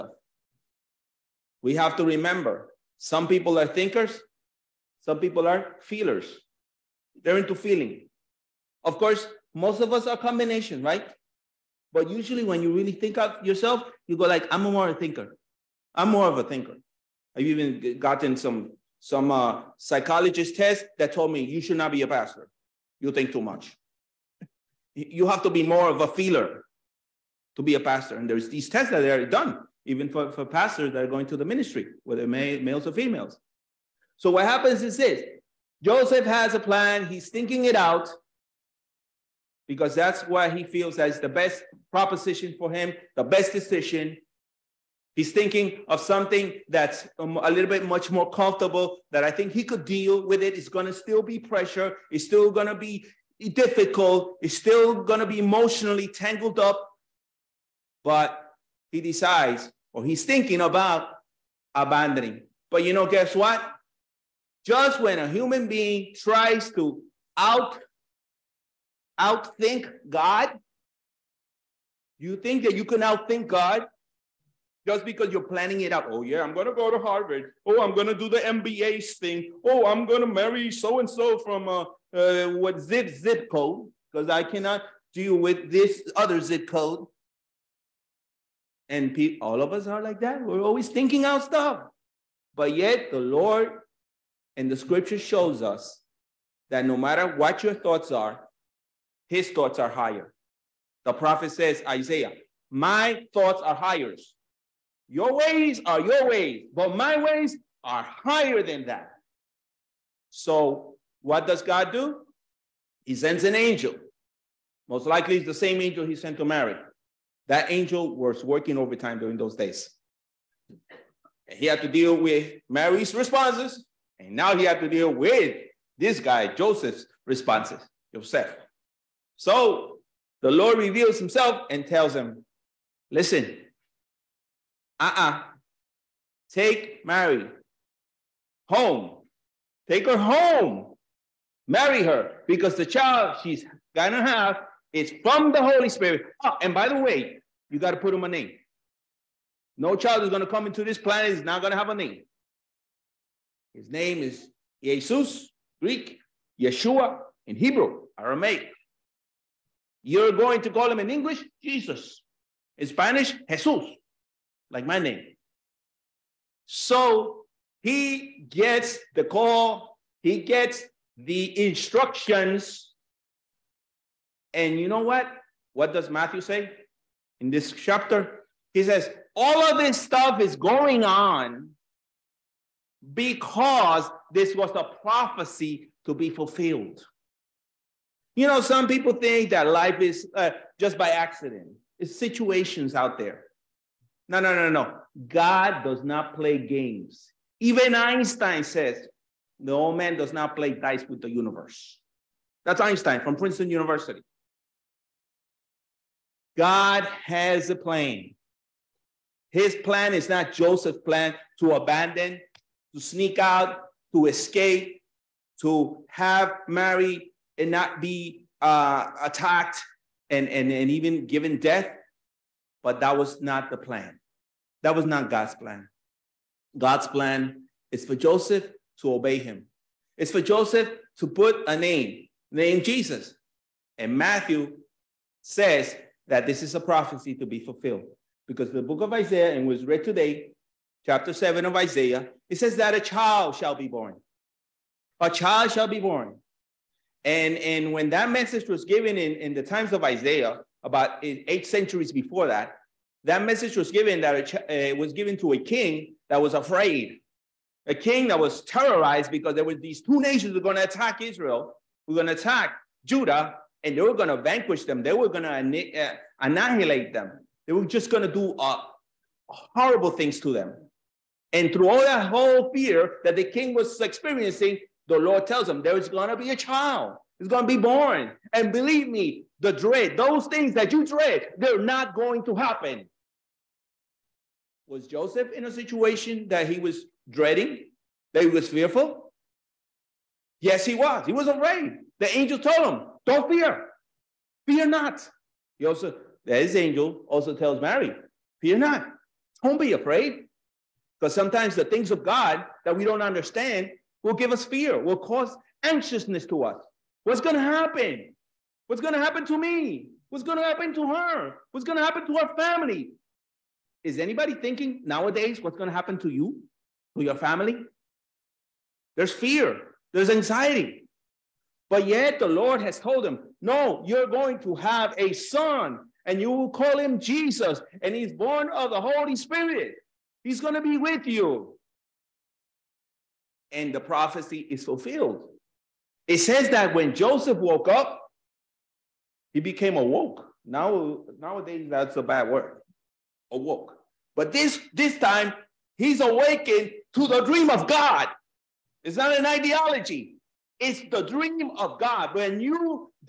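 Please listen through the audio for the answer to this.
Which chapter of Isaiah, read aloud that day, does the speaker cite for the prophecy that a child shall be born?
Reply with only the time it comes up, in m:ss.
4:01.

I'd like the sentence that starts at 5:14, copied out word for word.
Is anybody thinking nowadays what's going to happen to you, to your family?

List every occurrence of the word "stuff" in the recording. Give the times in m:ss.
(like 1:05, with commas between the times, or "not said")
1:31, 3:00.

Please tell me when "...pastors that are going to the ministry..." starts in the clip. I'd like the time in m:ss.
0:30.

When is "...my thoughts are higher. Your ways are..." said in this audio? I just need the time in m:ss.
1:42.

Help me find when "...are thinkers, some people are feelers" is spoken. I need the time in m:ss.
0:03.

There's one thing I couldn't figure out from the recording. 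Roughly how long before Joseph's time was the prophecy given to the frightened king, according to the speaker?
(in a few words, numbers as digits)
Eight centuries.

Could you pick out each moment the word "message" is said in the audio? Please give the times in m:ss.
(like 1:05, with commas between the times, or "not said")
4:08, 4:13.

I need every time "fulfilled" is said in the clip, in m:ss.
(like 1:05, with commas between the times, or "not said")
3:06, 3:57, 5:34.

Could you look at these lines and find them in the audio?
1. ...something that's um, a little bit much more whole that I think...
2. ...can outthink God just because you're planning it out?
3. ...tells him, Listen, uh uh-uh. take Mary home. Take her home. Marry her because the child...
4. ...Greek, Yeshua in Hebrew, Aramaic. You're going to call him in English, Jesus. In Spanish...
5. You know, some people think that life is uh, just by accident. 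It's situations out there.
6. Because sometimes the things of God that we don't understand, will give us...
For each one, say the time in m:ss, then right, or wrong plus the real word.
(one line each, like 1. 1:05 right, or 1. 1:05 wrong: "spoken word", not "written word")
1. 0:45 wrong: "comfortable", not "whole"
2. 1:12 right
3. 2:11 right
4. 2:35 right
5. 3:08 right
6. 5:01 right.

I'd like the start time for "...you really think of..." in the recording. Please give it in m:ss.
0:12.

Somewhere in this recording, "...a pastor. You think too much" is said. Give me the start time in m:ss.
0:22.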